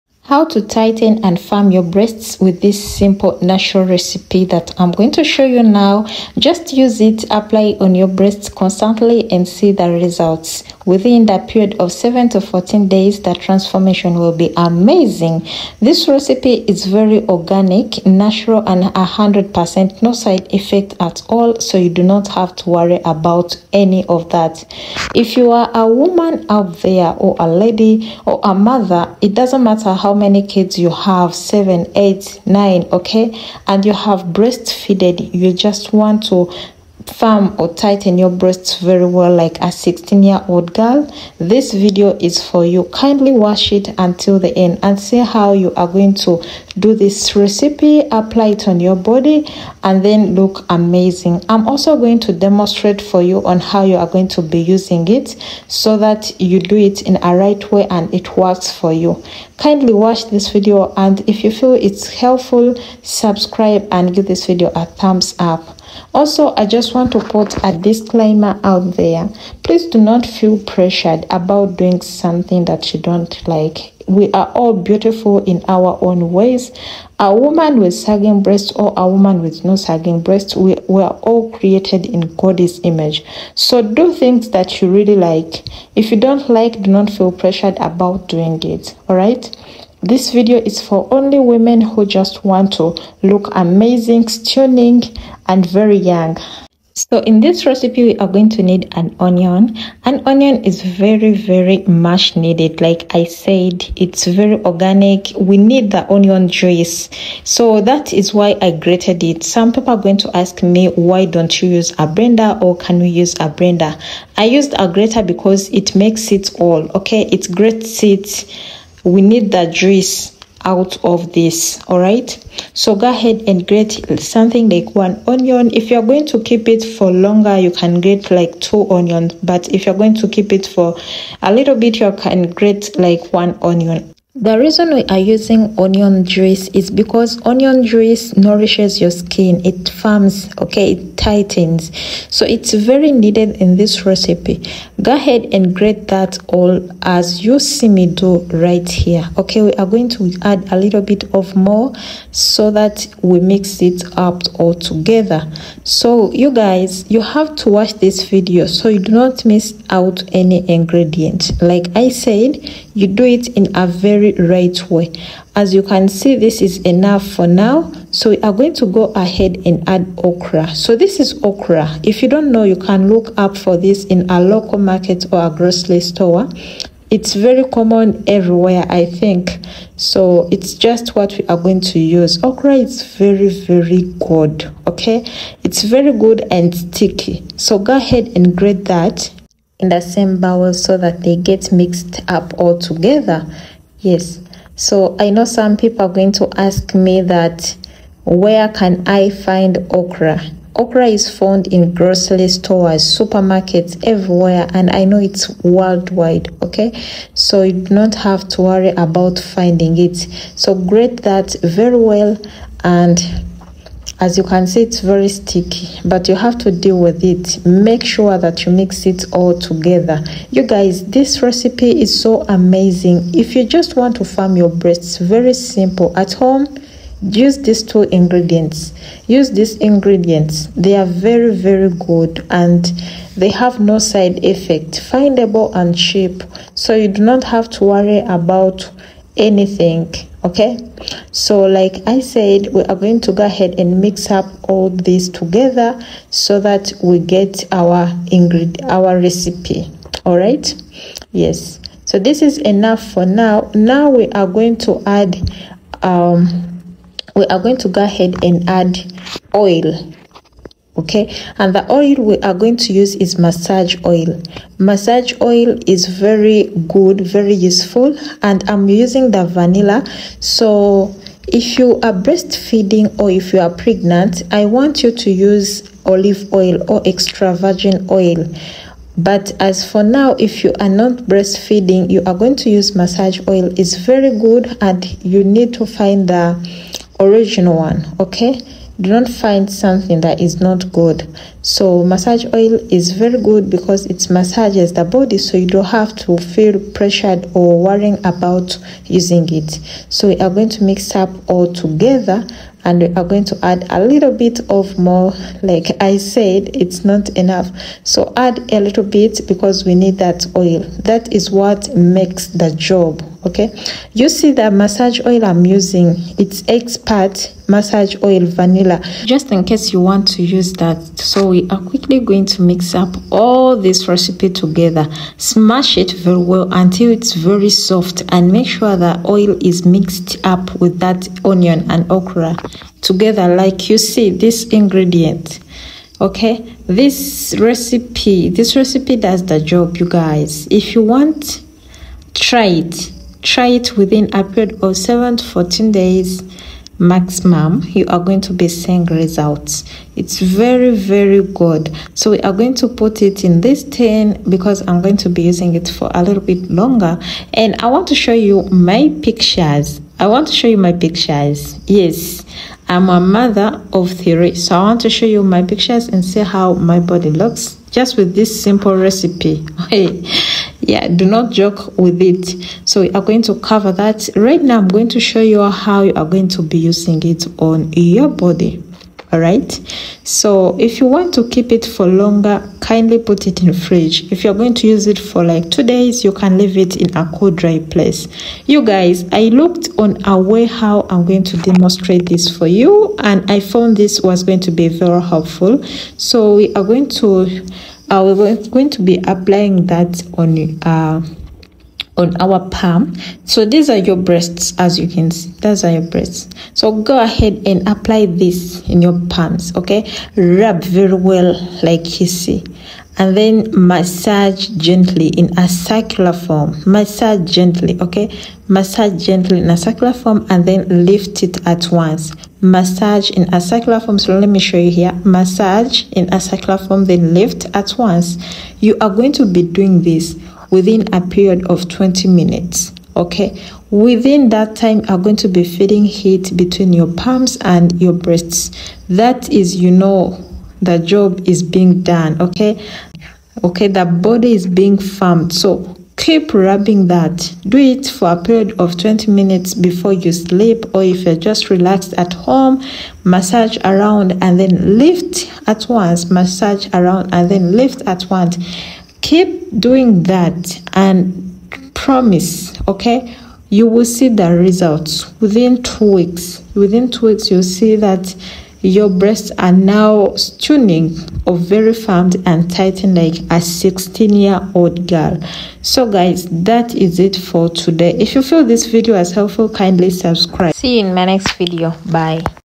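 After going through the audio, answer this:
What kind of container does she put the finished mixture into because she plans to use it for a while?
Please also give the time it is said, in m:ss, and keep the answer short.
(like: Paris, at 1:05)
tin, at 5:53.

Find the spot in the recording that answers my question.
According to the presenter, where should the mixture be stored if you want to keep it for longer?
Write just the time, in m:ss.
6:23.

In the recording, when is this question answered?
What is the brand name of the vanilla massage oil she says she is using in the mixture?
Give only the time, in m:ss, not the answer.
5:16.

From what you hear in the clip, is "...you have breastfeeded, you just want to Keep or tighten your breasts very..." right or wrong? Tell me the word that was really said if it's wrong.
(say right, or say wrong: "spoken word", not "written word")
wrong: "Firm", not "Keep".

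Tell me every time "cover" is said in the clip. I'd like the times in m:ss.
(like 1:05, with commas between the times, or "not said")
6:13.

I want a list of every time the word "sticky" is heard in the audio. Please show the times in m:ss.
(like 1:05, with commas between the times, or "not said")
3:06, 3:35.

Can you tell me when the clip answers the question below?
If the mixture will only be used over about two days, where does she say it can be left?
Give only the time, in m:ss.
6:27.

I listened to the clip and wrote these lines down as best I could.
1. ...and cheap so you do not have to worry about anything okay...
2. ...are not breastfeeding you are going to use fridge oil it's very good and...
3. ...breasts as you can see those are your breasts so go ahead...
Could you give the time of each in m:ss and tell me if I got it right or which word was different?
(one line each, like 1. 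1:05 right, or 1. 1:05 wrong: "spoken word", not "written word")
1. 3:55 right
2. 4:40 wrong: "massage", not "fridge"
3. 6:44 right.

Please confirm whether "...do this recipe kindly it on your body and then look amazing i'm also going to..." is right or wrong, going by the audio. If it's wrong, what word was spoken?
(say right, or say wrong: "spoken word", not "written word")
wrong: "apply", not "kindly".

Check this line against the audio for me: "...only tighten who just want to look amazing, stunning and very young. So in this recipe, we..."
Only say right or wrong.
wrong.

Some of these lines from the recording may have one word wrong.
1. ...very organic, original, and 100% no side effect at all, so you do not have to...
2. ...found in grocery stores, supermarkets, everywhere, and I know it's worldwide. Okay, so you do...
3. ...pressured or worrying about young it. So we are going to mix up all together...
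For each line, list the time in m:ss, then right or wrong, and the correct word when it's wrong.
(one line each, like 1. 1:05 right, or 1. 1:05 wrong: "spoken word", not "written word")
1. 0:16 wrong: "natural", not "original"
2. 3:21 right
3. 4:56 wrong: "using", not "young".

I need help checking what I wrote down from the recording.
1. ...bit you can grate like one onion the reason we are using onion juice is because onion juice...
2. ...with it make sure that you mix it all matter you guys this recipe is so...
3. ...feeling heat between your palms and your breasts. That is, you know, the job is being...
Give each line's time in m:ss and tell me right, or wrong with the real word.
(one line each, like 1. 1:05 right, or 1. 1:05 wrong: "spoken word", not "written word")
1. 2:11 right
2. 3:36 wrong: "together", not "matter"
3. 7:15 right.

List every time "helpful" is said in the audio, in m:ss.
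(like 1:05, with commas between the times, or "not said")
1:02, 6:35, 7:59.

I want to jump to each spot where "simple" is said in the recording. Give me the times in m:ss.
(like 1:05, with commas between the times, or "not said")
0:02, 3:45, 6:08.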